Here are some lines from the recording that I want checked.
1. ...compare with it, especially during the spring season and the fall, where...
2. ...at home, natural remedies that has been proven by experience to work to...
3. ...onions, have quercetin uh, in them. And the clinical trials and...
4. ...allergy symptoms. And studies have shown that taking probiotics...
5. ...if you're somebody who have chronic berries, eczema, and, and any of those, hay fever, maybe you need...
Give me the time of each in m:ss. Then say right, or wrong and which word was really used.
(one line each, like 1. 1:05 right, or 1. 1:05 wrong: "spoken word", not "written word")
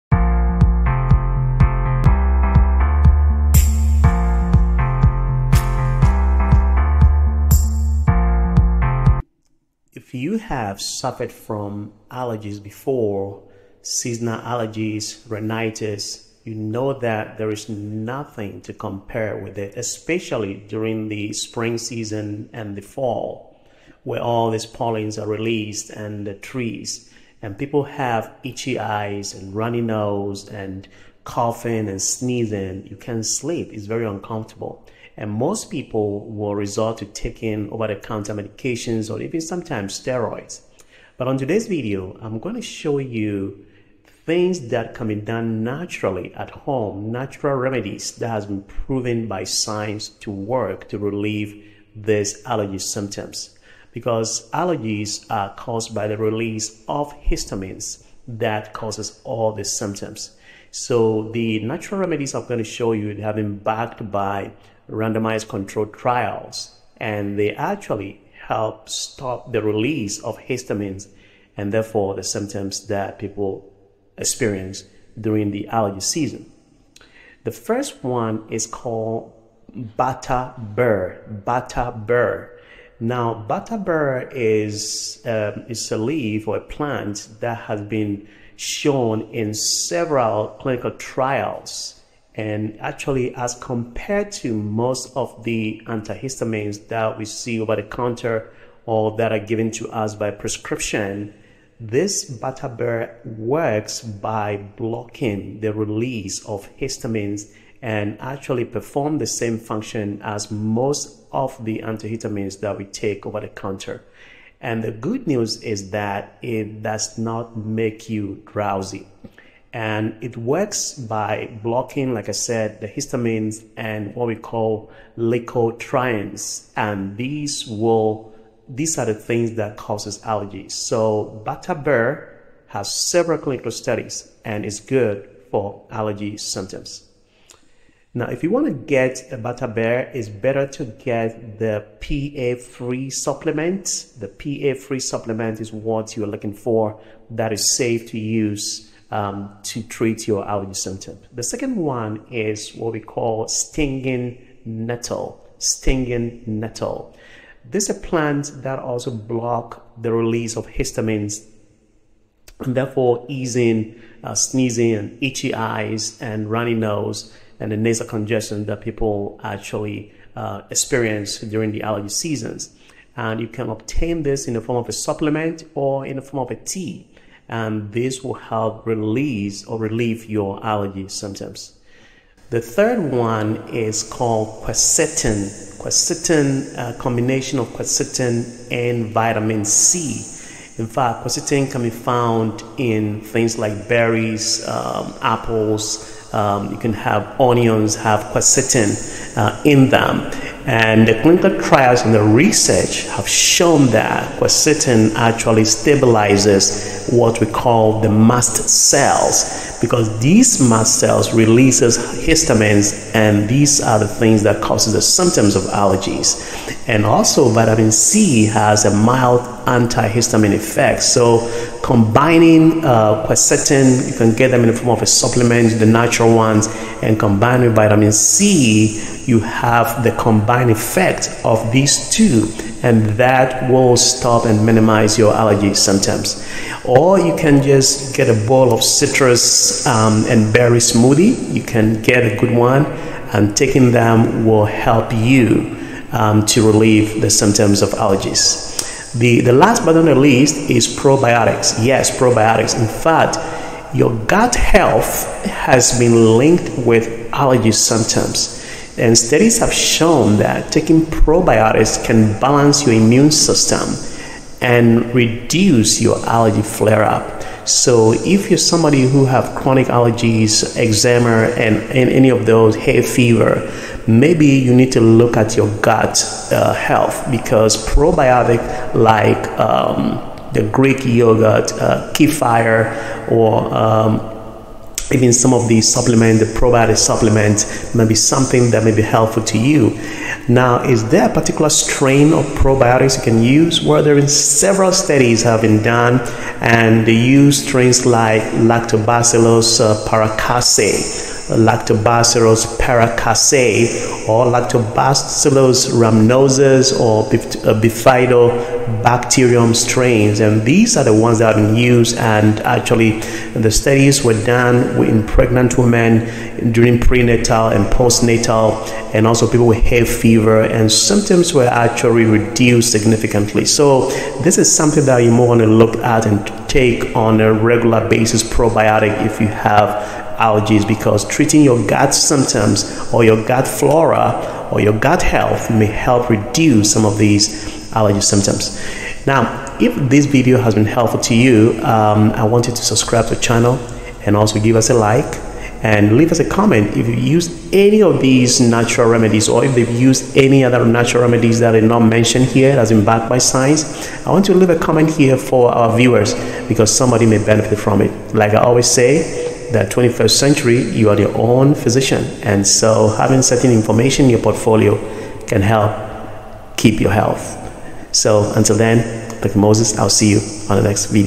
1. 0:18 right
2. 0:46 wrong: "science", not "experience"
3. 3:17 right
4. 4:17 right
5. 4:28 wrong: "allergies", not "berries".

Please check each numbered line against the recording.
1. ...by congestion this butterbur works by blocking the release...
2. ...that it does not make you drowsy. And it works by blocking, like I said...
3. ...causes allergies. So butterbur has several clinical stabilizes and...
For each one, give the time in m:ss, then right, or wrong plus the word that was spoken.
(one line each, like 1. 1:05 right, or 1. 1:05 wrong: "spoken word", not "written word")
1. 1:40 wrong: "prescription", not "congestion"
2. 1:55 right
3. 2:09 wrong: "studies", not "stabilizes".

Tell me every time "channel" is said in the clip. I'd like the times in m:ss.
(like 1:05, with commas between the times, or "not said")
5:43.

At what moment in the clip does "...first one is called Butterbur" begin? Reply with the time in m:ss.
1:17.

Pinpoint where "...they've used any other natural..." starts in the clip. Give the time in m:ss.
5:49.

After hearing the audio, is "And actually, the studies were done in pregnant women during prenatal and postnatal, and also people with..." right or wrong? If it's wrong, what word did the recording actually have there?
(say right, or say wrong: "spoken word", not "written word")
right.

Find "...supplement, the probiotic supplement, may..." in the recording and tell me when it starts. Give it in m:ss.
4:45.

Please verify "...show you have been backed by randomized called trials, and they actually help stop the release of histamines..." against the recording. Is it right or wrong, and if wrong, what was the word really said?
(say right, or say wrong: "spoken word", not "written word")
wrong: "controlled", not "called".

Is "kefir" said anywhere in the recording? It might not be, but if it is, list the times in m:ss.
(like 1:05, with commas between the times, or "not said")
4:42.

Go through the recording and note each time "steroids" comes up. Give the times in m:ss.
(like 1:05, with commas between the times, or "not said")
0:39.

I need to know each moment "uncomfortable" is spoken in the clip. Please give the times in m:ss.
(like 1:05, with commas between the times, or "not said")
0:34.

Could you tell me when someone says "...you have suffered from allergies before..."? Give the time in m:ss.
0:10.